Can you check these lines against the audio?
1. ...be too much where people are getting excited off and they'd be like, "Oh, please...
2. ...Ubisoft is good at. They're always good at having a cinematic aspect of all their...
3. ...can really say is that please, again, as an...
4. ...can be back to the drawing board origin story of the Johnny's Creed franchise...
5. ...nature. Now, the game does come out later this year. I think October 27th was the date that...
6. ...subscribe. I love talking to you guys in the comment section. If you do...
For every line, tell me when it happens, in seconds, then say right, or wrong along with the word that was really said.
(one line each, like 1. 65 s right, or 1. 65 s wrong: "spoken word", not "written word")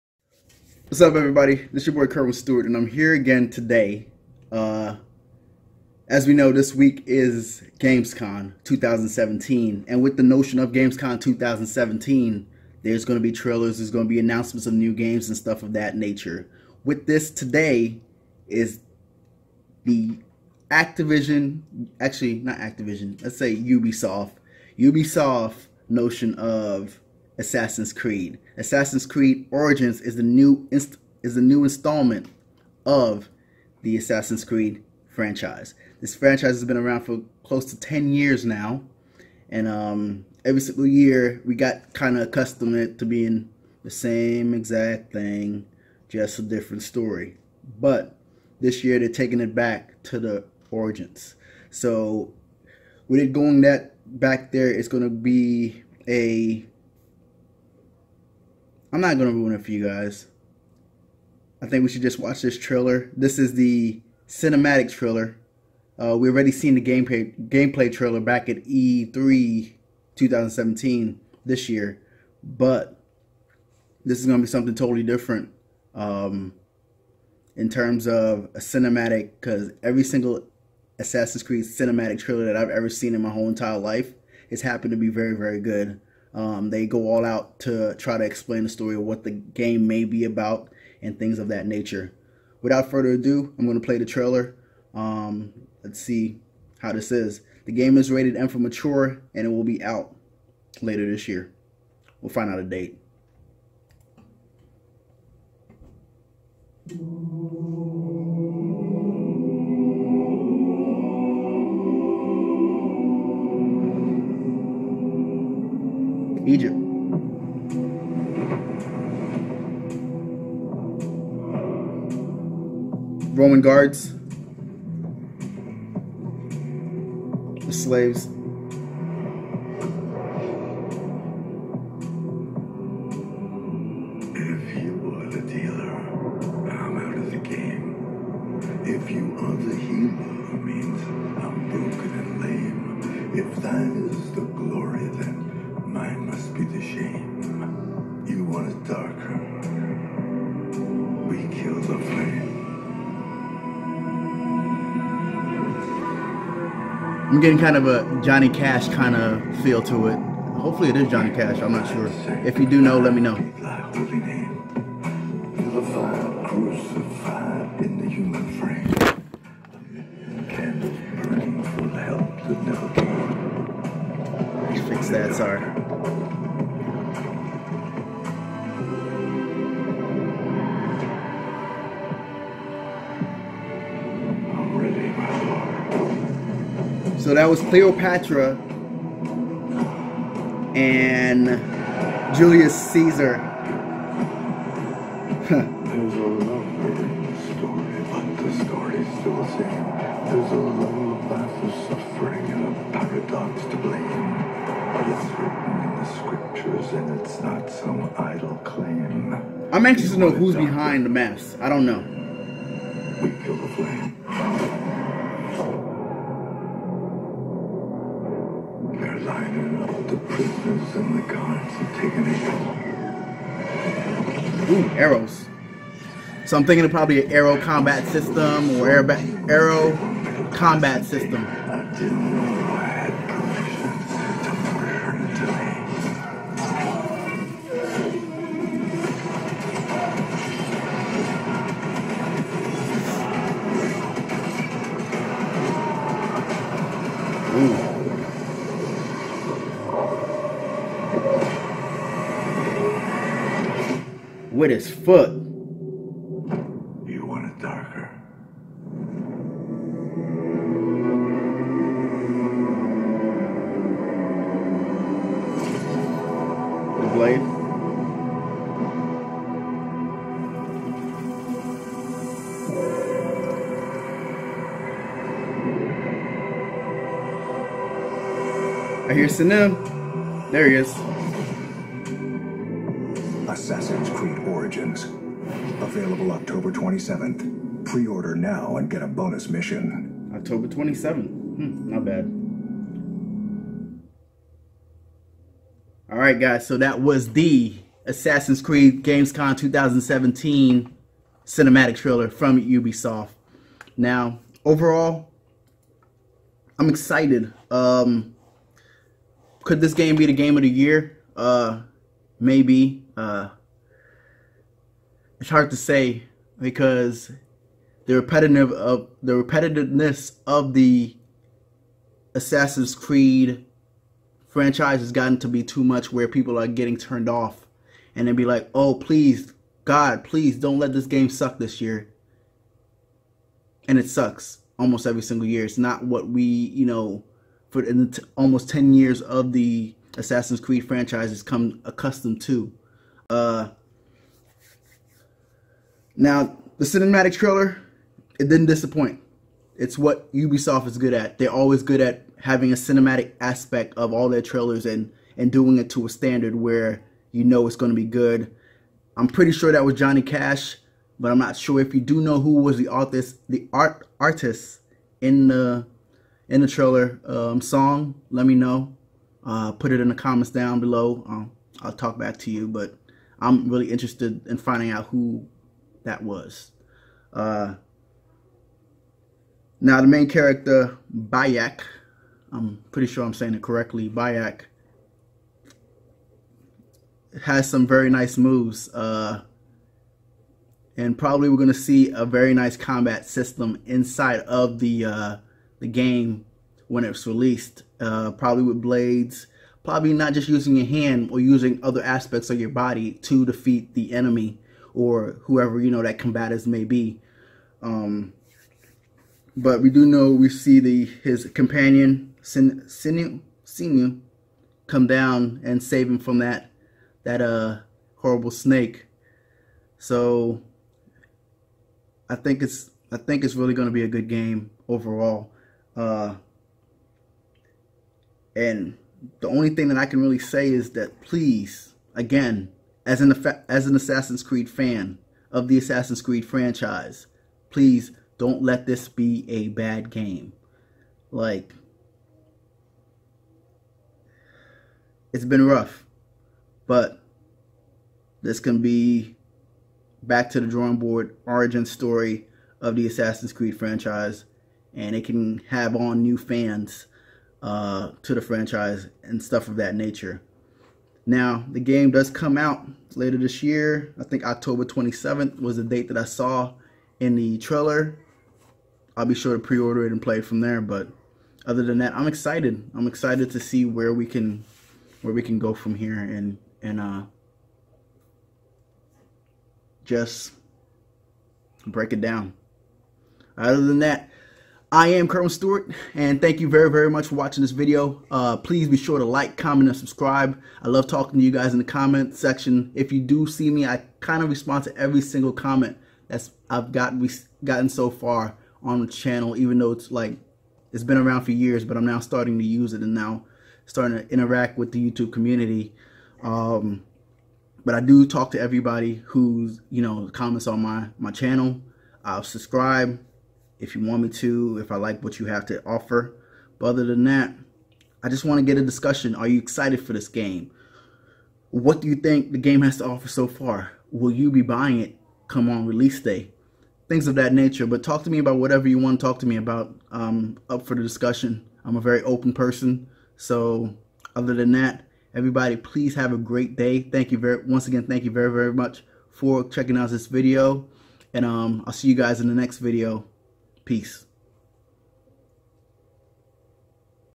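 1. 325 s wrong: "turned", not "excited"
2. 350 s right
3. 430 s right
4. 448 s wrong: "Assassin", not "Johnny"
5. 459 s right
6. 489 s right.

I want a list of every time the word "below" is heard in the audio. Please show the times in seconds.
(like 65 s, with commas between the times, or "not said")
370 s.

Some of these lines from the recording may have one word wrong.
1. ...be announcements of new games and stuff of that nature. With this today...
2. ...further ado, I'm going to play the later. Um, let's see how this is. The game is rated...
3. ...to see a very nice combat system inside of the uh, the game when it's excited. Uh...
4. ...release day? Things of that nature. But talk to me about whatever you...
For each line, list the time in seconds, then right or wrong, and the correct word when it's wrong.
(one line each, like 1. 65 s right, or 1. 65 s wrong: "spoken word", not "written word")
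1. 14 s right
2. 92 s wrong: "trailer", not "later"
3. 391 s wrong: "released", not "excited"
4. 525 s right.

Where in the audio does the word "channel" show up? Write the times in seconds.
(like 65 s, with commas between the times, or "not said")
499 s, 511 s.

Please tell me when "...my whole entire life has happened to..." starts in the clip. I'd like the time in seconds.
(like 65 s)
83 s.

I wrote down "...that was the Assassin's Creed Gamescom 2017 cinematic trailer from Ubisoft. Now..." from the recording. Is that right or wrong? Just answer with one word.
right.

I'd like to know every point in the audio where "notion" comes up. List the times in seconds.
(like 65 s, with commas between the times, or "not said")
10 s, 25 s.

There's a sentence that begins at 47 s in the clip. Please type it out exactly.
But this year they're taking it back to the origins.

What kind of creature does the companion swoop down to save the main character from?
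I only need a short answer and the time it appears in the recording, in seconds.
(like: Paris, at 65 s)
snake, at 418 s.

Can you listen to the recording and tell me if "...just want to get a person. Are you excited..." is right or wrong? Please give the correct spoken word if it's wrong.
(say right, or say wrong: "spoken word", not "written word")
wrong: "discussion", not "person".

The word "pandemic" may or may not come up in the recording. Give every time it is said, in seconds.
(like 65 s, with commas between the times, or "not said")
not said.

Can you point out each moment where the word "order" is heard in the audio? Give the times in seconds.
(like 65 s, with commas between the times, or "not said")
288 s, 469 s.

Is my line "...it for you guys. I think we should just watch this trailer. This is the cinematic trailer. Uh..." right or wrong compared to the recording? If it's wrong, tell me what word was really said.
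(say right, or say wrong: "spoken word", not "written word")
right.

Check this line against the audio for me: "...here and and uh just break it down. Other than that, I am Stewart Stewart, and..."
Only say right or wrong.
wrong.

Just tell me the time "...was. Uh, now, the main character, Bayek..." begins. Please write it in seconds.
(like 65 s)
376 s.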